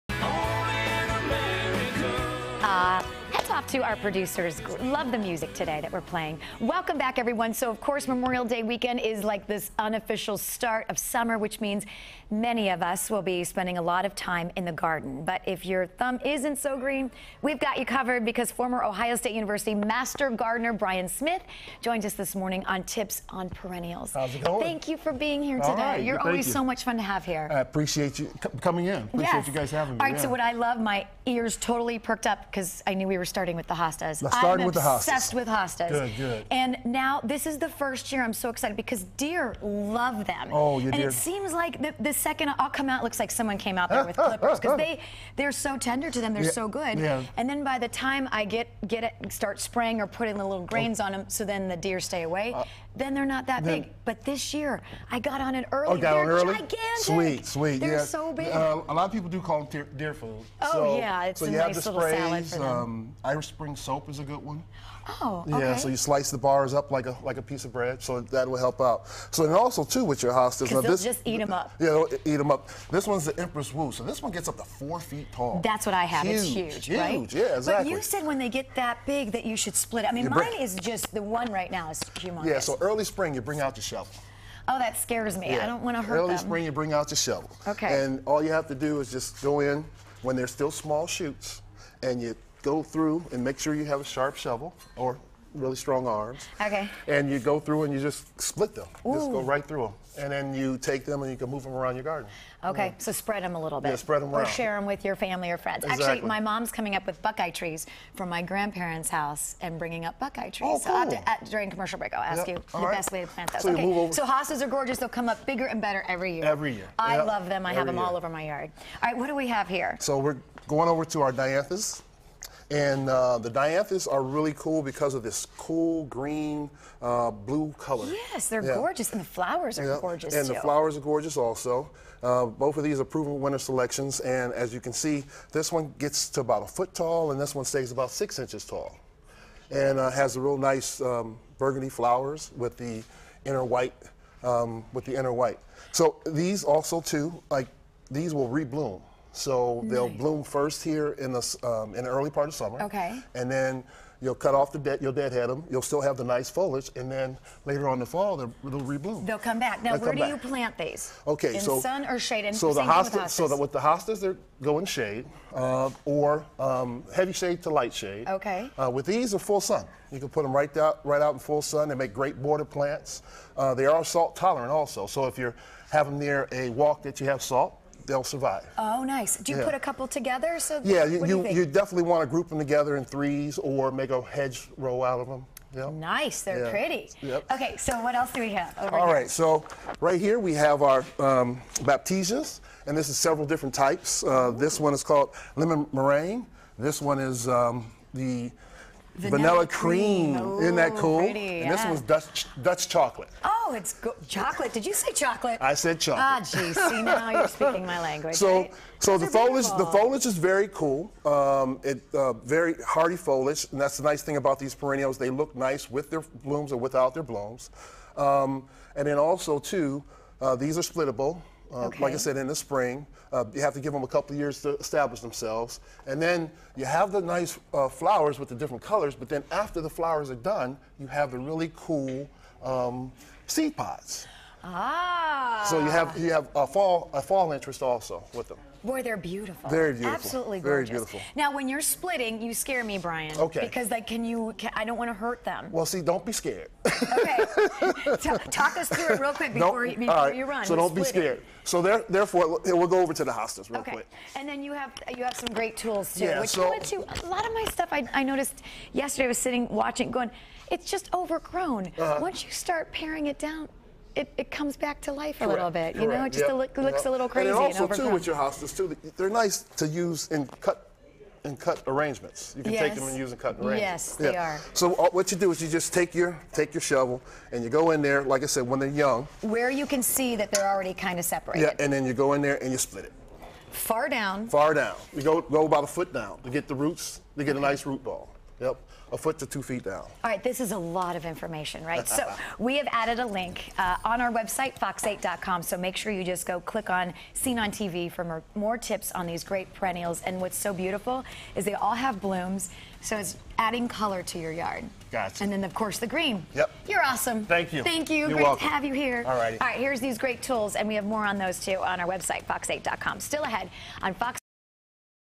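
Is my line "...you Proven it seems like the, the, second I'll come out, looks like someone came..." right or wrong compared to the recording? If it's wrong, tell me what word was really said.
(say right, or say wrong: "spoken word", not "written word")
wrong: "And", not "Proven".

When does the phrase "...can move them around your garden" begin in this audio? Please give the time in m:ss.
1:41.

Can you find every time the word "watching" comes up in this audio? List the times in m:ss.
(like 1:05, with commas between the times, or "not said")
4:19.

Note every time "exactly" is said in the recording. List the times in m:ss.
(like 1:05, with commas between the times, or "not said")
1:17, 1:45.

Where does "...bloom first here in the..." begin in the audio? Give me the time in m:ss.
2:30.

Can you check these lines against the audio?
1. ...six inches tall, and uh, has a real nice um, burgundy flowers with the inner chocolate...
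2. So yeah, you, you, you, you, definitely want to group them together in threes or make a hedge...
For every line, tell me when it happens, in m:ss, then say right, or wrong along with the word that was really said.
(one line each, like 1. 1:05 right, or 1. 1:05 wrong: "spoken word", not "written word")
1. 2:18 wrong: "white", not "chocolate"
2. 3:00 right.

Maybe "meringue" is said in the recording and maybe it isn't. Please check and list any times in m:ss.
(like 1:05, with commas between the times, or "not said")
3:15.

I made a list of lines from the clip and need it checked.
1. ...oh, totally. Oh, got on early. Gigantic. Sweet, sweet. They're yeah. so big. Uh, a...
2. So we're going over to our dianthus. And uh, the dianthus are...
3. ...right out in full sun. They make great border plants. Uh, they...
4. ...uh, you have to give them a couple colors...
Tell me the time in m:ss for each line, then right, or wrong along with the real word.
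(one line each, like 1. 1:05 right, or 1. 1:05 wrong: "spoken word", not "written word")
1. 0:55 wrong: "early", not "totally"
2. 2:00 right
3. 2:51 right
4. 3:43 wrong: "years", not "colors".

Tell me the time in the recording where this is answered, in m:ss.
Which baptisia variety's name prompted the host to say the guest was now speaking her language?
3:22.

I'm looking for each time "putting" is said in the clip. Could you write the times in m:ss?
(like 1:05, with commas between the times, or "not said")
0:50.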